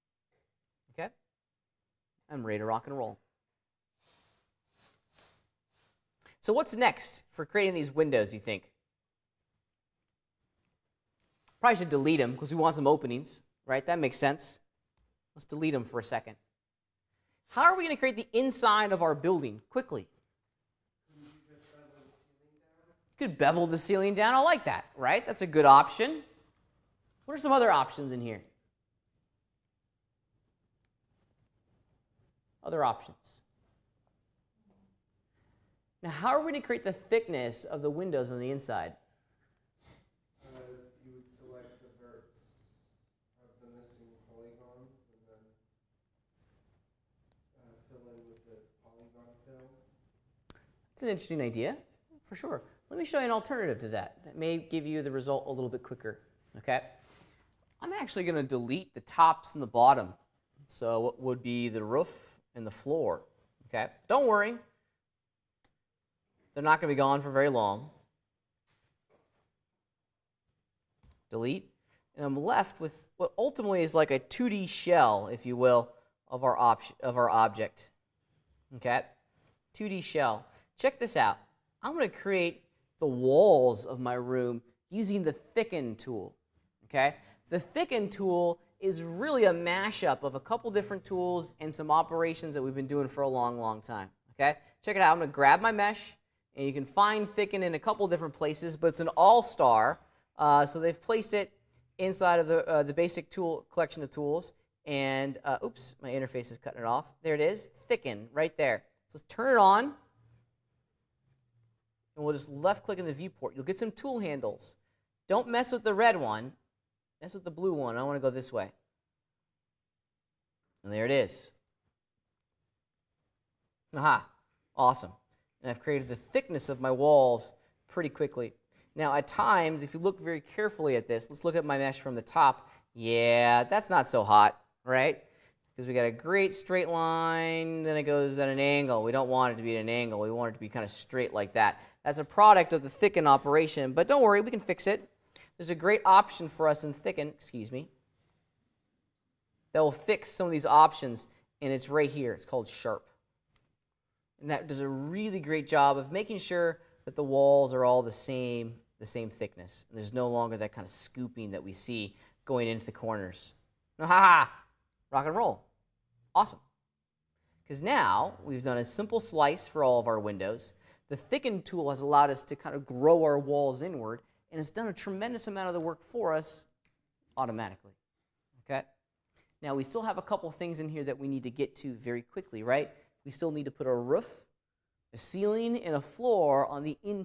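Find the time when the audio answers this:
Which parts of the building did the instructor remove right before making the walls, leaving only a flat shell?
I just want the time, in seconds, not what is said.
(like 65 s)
58 s.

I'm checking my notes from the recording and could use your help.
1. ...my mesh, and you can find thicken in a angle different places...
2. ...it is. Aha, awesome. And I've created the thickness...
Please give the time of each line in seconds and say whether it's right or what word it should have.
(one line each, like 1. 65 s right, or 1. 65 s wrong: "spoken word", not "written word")
1. 95 s wrong: "couple", not "angle"
2. 121 s right.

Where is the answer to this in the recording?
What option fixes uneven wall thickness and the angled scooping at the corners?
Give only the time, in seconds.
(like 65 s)
152 s.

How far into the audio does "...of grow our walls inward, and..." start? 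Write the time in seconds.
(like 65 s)
172 s.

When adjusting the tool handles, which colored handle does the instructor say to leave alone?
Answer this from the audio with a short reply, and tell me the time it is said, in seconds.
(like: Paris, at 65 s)
The red one, at 115 s.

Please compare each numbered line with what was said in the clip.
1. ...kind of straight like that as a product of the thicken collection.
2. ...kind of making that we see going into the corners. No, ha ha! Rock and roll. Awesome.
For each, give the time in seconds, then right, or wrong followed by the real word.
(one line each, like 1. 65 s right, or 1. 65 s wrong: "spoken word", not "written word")
1. 140 s wrong: "operation", not "collection"
2. 160 s wrong: "scooping", not "making".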